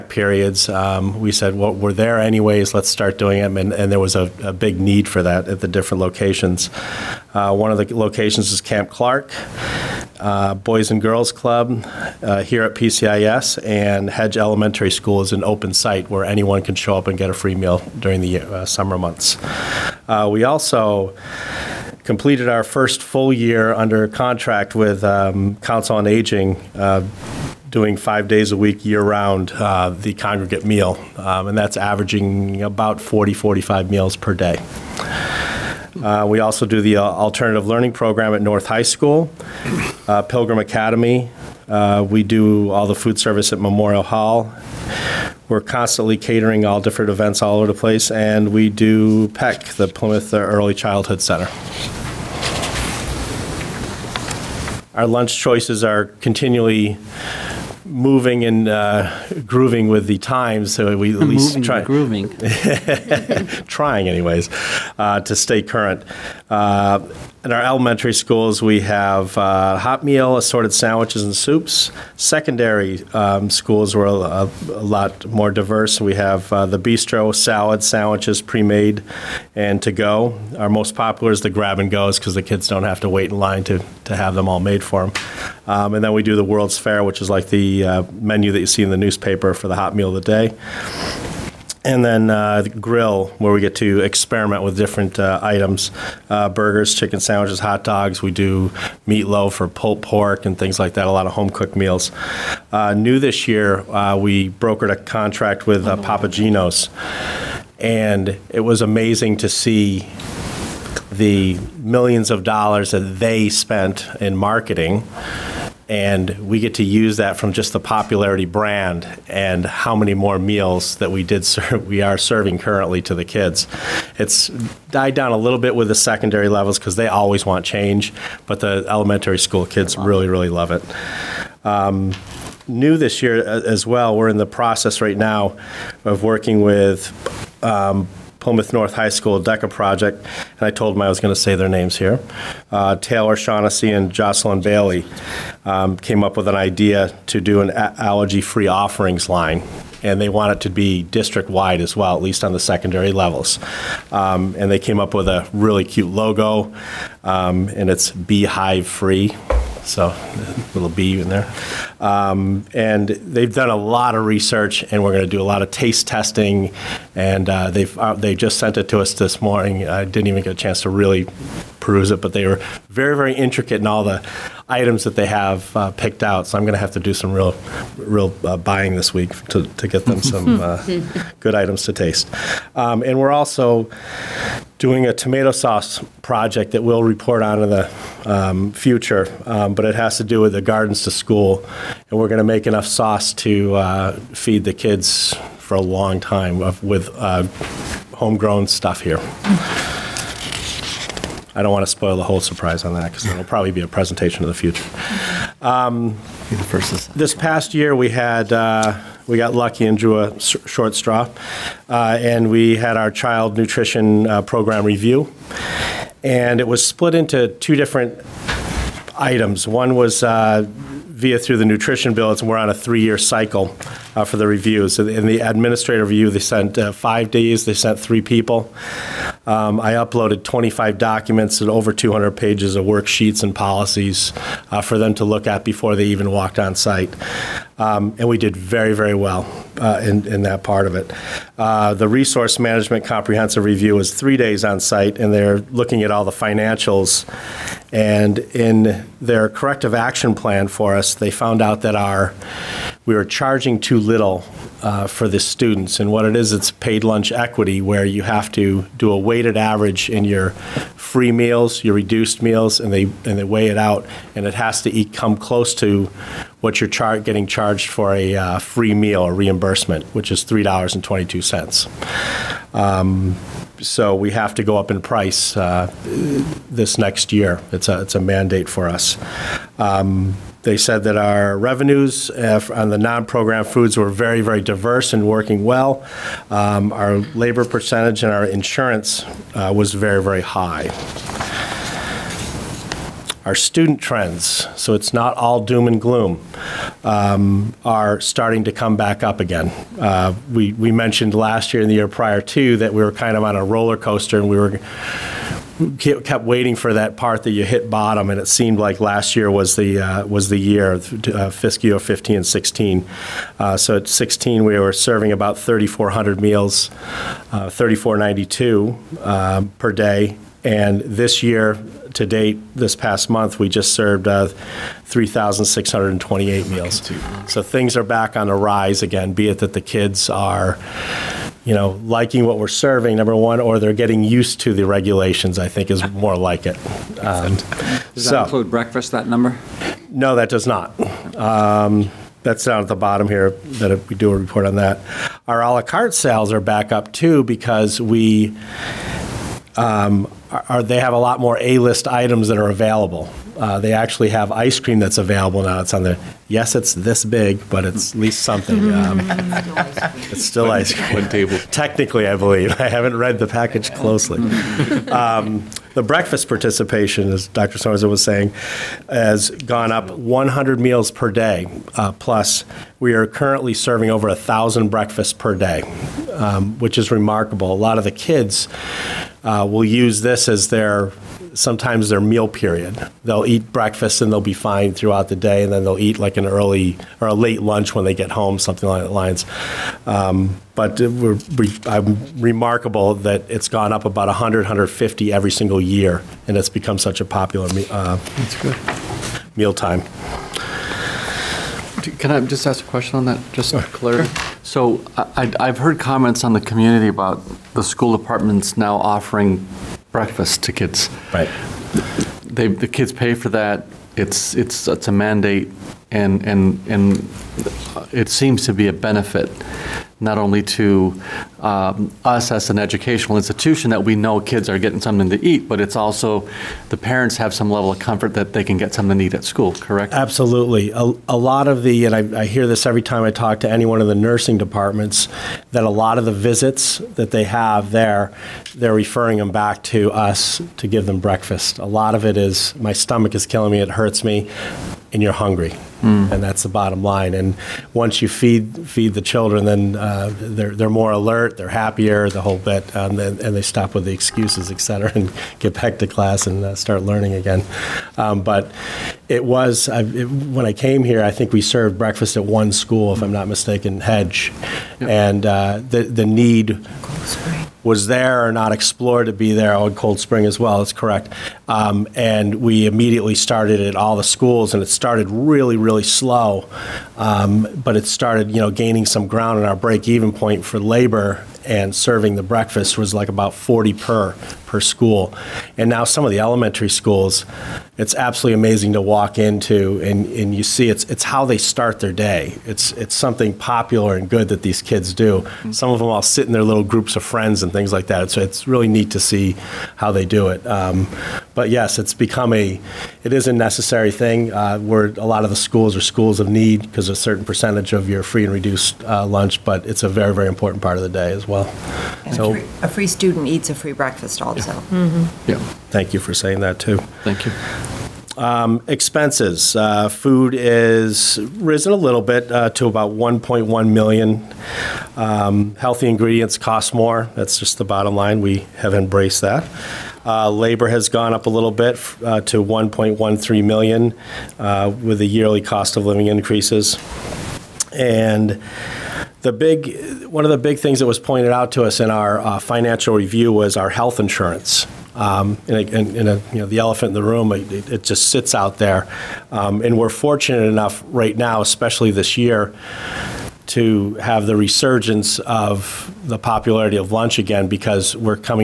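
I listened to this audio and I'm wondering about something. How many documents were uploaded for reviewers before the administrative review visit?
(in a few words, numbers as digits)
25.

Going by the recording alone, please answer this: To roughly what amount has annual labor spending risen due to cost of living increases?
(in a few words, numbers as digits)
1.13 million.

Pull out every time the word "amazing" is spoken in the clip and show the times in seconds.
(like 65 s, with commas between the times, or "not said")
108 s, 488 s.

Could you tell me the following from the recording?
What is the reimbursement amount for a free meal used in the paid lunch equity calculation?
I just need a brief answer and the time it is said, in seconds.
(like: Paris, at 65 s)
$3.22, at 270 s.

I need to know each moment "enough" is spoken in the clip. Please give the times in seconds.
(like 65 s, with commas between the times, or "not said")
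192 s, 550 s.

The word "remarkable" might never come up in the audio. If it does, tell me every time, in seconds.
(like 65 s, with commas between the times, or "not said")
377 s, 392 s.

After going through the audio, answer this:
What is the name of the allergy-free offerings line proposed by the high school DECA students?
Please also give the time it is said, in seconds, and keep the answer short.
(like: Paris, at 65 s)
beehive free, at 158 s.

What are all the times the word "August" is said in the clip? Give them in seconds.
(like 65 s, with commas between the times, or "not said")
not said.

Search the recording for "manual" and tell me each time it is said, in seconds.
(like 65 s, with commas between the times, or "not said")
not said.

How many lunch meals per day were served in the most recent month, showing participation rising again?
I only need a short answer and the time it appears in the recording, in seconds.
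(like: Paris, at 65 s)
3,628, at 325 s.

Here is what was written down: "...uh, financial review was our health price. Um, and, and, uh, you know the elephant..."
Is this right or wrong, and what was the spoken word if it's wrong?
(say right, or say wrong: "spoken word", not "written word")
wrong: "insurance", not "price".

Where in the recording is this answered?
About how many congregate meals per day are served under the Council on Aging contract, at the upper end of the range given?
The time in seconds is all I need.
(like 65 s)
33 s.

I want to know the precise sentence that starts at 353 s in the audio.
Uh, they actually have ice cream that's available now.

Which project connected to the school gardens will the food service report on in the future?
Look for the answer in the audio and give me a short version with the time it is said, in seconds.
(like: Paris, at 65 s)
tomato sauce project, at 185 s.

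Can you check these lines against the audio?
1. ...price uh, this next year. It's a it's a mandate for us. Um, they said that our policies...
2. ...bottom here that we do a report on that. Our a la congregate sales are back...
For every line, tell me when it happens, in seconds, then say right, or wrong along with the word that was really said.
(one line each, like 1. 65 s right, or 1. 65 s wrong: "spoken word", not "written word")
1. 275 s wrong: "revenues", not "policies"
2. 342 s wrong: "carte", not "congregate".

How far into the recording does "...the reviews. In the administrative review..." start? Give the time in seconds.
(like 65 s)
224 s.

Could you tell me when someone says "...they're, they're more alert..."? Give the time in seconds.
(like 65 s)
450 s.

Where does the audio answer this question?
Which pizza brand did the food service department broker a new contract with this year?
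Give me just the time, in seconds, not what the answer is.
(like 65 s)
106 s.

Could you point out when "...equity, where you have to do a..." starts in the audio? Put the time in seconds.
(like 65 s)
257 s.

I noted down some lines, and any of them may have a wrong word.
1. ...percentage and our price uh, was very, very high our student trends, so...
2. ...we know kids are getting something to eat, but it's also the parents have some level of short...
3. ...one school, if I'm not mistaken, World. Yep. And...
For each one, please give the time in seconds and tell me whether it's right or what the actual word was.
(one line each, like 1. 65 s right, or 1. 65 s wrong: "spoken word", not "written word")
1. 287 s wrong: "insurance", not "price"
2. 424 s wrong: "comfort", not "short"
3. 462 s wrong: "Hedge", not "World".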